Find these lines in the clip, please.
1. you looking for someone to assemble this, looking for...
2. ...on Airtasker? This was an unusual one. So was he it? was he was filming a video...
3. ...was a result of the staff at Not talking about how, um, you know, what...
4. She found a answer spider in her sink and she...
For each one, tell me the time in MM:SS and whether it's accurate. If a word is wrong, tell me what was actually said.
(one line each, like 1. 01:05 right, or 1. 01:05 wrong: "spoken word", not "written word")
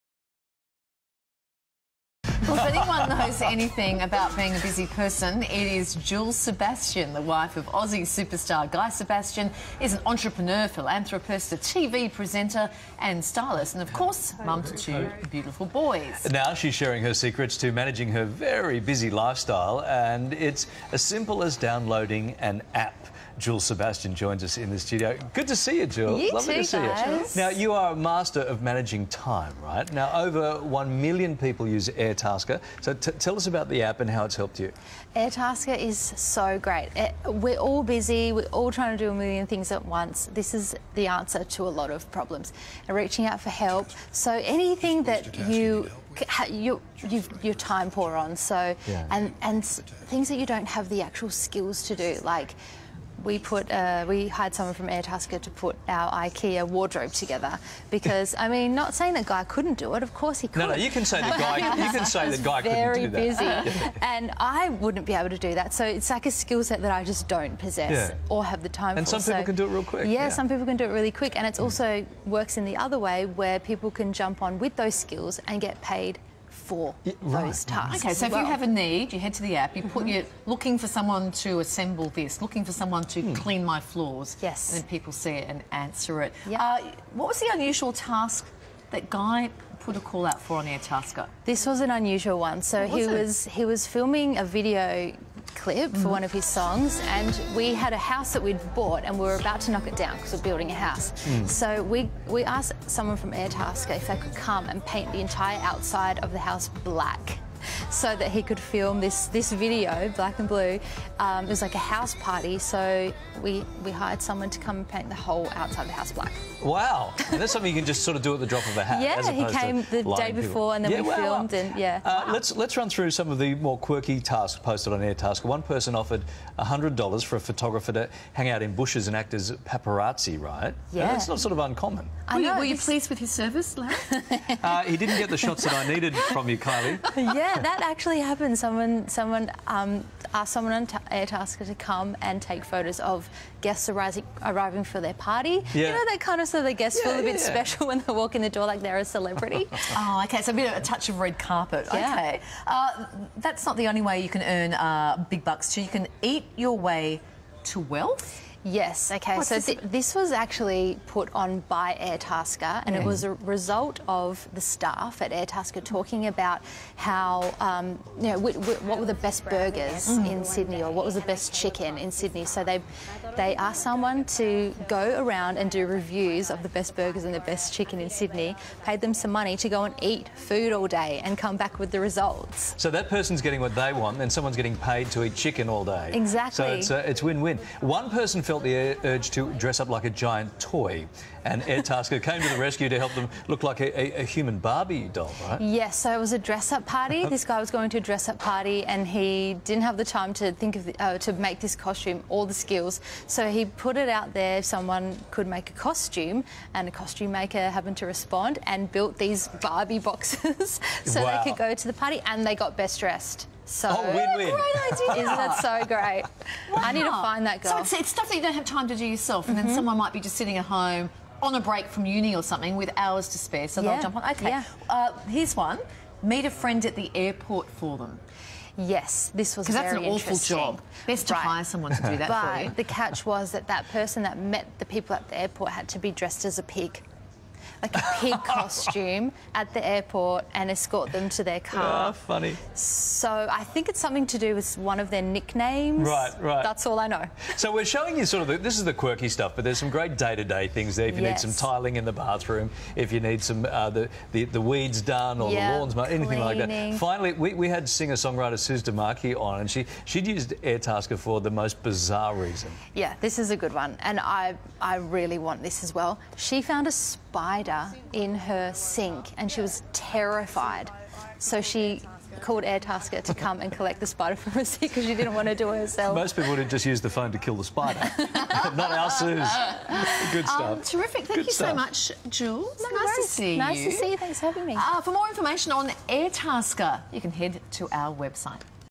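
1. 01:20 right
2. 01:30 right
3. 02:43 wrong: "Airtasker", not "Not"
4. 04:26 wrong: "spider", not "answer".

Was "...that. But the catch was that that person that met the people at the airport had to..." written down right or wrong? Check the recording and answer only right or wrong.
right.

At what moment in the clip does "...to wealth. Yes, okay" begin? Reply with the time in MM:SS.
02:37.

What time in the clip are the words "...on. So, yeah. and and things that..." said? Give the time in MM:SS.
00:48.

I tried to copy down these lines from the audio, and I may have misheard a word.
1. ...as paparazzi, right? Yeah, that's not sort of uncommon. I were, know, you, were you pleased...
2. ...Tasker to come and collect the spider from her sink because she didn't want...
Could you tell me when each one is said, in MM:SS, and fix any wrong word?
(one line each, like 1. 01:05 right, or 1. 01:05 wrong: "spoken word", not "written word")
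1. 02:09 right
2. 04:32 right.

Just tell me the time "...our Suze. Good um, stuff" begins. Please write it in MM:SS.
04:38.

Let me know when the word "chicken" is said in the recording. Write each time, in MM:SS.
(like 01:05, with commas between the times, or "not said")
02:51, 02:57, 03:05.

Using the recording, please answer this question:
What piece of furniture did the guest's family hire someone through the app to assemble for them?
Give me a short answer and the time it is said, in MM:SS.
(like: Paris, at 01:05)
IKEA wardrobe, at 00:56.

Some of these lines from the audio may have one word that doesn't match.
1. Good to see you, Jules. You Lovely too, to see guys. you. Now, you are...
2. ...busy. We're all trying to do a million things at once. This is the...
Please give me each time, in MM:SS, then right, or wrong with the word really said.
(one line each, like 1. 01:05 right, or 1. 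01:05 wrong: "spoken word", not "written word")
1. 00:25 right
2. 00:37 right.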